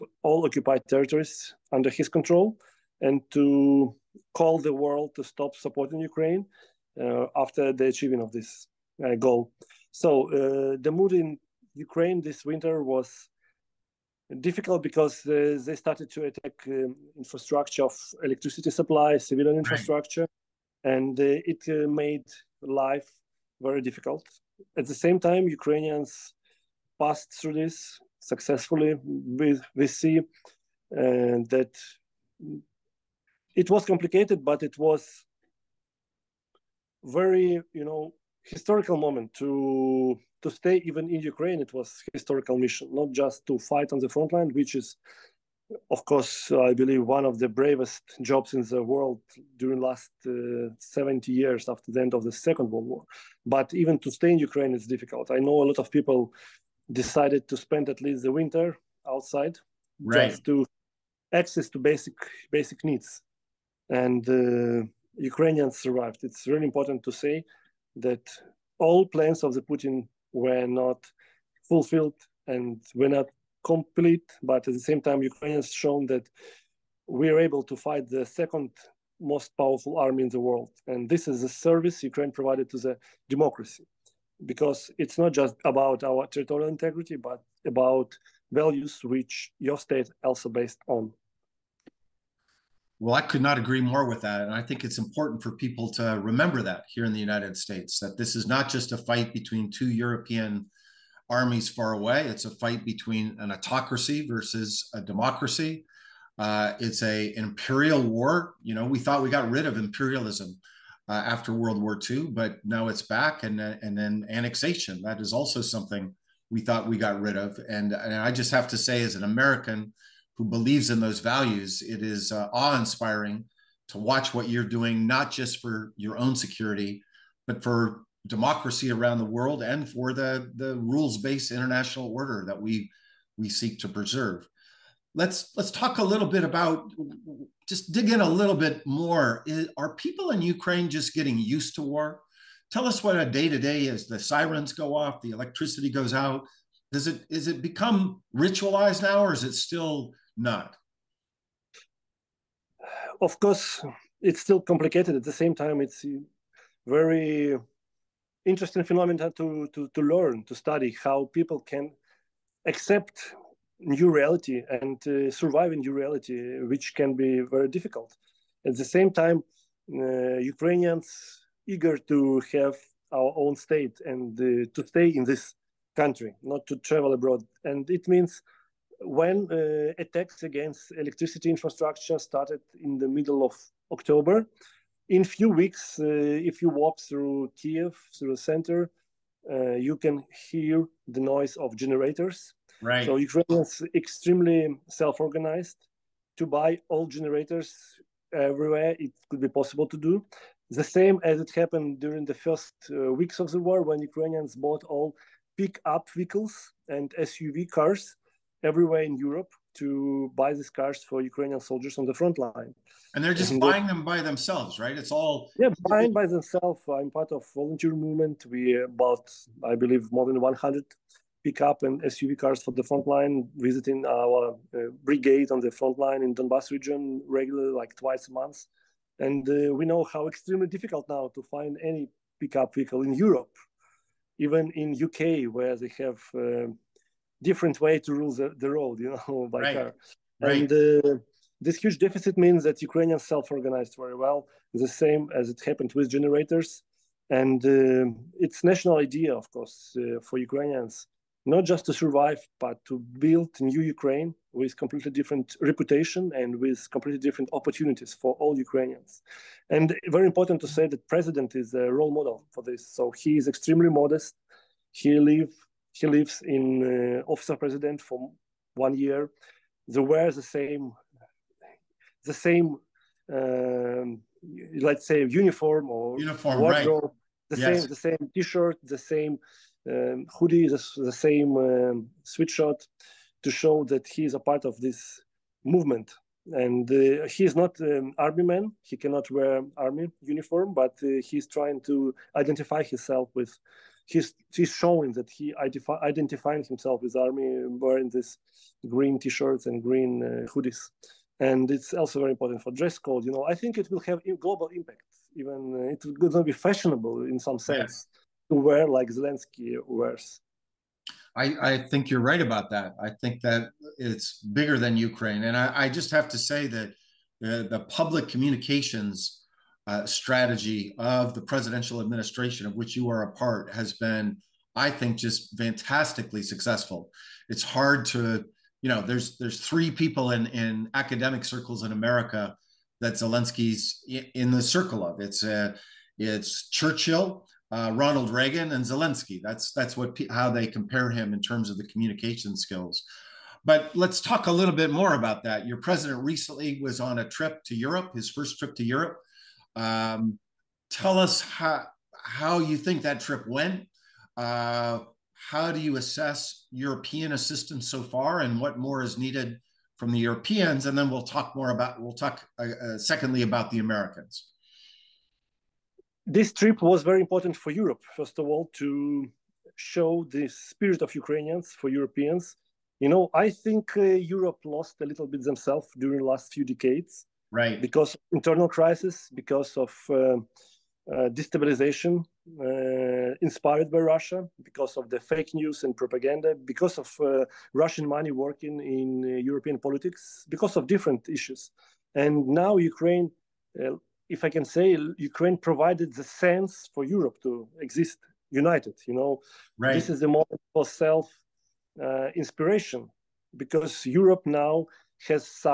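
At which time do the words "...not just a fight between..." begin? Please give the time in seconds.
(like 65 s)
98 s.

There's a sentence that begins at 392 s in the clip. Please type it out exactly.
And now Ukraine, uh, if I can say, Ukraine provided the sense for Europe to exist united.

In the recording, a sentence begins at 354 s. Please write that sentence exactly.
Uh, how do you assess European assistance so far and what more is needed from the Europeans?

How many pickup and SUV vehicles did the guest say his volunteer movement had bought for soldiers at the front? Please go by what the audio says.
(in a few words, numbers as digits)
More than 100.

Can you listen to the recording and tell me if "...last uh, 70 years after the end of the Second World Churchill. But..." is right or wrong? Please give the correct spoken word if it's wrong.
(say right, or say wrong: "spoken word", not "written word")
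wrong: "War", not "Churchill".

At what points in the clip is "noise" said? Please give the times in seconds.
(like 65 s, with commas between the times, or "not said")
191 s.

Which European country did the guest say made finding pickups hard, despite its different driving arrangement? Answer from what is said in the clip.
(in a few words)
UK.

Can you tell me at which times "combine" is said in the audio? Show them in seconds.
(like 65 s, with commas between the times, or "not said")
not said.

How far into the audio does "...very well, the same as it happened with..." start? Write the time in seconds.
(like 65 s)
243 s.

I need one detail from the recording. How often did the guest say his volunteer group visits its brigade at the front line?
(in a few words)
Twice a month.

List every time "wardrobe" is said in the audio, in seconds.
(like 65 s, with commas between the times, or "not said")
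276 s.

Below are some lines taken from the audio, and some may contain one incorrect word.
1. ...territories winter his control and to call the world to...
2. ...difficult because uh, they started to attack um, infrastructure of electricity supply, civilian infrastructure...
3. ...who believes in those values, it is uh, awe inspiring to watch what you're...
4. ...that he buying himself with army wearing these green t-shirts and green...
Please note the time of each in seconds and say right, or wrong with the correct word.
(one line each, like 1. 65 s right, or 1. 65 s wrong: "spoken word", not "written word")
1. 0 s wrong: "under", not "winter"
2. 14 s right
3. 120 s right
4. 295 s wrong: "identifying", not "buying".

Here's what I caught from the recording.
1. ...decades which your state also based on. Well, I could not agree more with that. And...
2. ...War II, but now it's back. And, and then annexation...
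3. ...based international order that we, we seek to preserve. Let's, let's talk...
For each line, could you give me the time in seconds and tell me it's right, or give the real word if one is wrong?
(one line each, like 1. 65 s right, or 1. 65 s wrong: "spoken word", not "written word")
1. 88 s wrong: "values", not "decades"
2. 111 s right
3. 131 s right.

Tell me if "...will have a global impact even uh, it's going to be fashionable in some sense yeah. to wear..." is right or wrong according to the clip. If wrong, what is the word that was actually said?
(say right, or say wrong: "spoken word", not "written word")
right.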